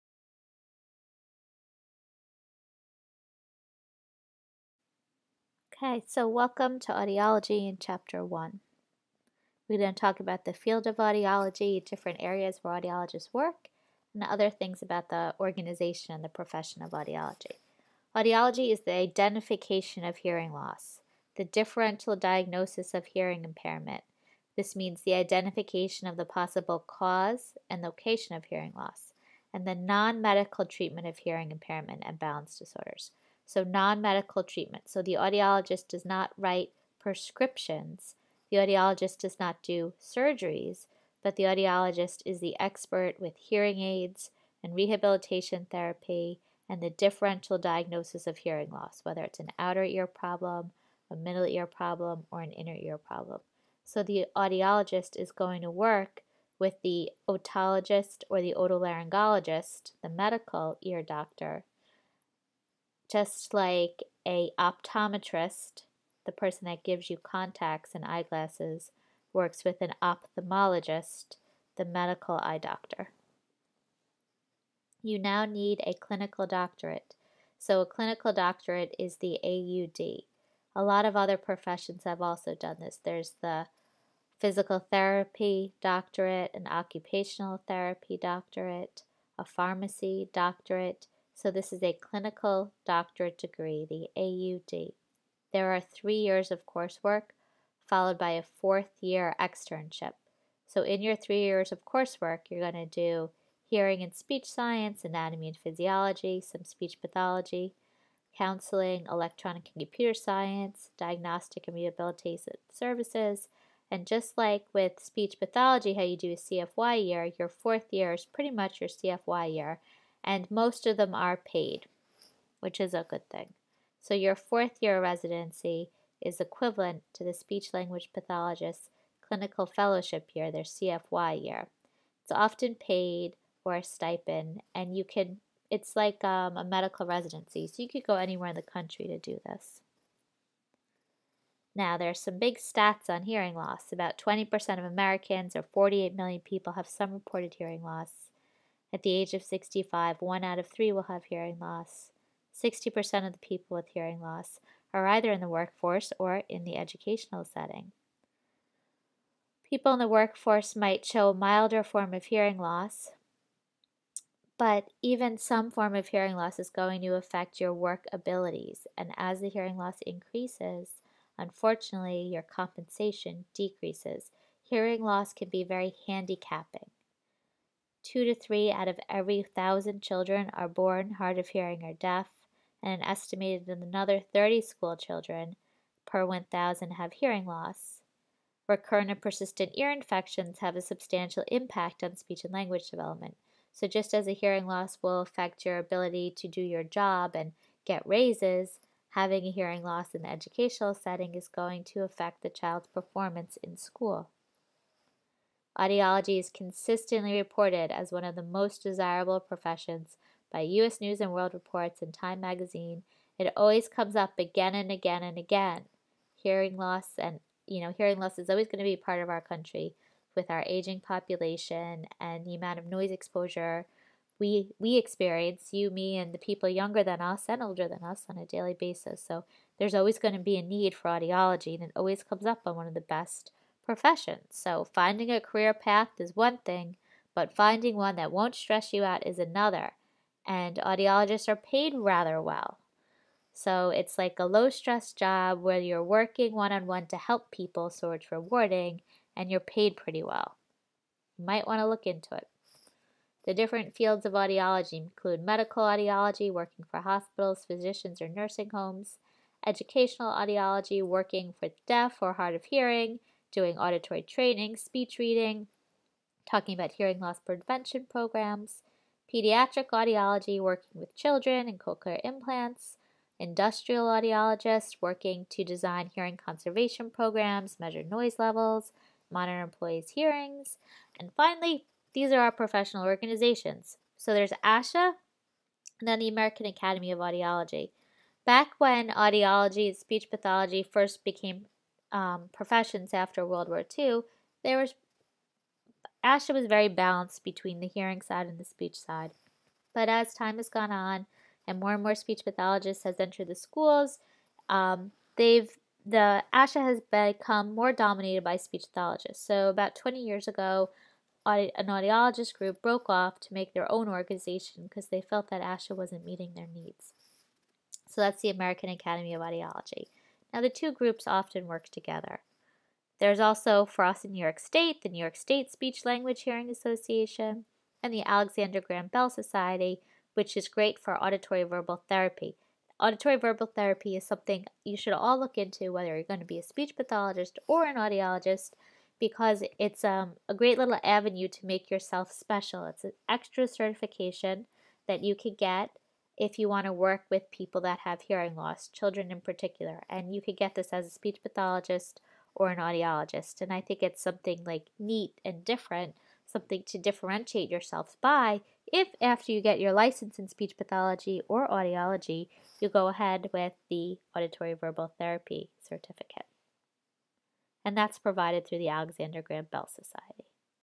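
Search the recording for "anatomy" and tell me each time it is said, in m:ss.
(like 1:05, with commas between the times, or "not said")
1:45.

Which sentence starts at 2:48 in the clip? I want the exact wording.
And as the hearing loss increases, unfortunately, your compensation decreases.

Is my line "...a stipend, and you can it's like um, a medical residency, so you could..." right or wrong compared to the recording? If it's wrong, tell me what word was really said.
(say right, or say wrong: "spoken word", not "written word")
right.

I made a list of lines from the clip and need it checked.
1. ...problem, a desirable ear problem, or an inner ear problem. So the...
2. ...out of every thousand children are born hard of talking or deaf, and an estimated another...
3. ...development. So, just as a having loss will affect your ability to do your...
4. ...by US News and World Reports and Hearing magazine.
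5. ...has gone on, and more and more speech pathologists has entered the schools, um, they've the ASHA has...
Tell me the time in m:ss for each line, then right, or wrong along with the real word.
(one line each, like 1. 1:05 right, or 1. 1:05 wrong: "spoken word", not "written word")
1. 0:50 wrong: "middle", not "desirable"
2. 2:58 wrong: "hearing", not "talking"
3. 3:12 wrong: "hearing", not "having"
4. 3:30 wrong: "Time", not "Hearing"
5. 5:00 right.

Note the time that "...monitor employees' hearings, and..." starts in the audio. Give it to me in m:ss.
4:39.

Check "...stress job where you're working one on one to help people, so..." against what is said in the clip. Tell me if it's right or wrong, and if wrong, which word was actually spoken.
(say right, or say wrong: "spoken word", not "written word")
right.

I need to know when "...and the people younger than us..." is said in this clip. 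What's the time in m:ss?
3:46.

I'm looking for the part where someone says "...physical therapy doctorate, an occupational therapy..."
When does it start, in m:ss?
1:24.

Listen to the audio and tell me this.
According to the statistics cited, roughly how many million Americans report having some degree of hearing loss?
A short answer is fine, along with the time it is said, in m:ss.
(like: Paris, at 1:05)
48 million, at 2:25.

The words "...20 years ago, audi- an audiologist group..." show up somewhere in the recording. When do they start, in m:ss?
5:09.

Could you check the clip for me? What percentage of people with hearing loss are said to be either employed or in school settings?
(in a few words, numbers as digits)
60%.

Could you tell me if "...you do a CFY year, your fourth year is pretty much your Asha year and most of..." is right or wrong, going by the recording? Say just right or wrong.
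wrong.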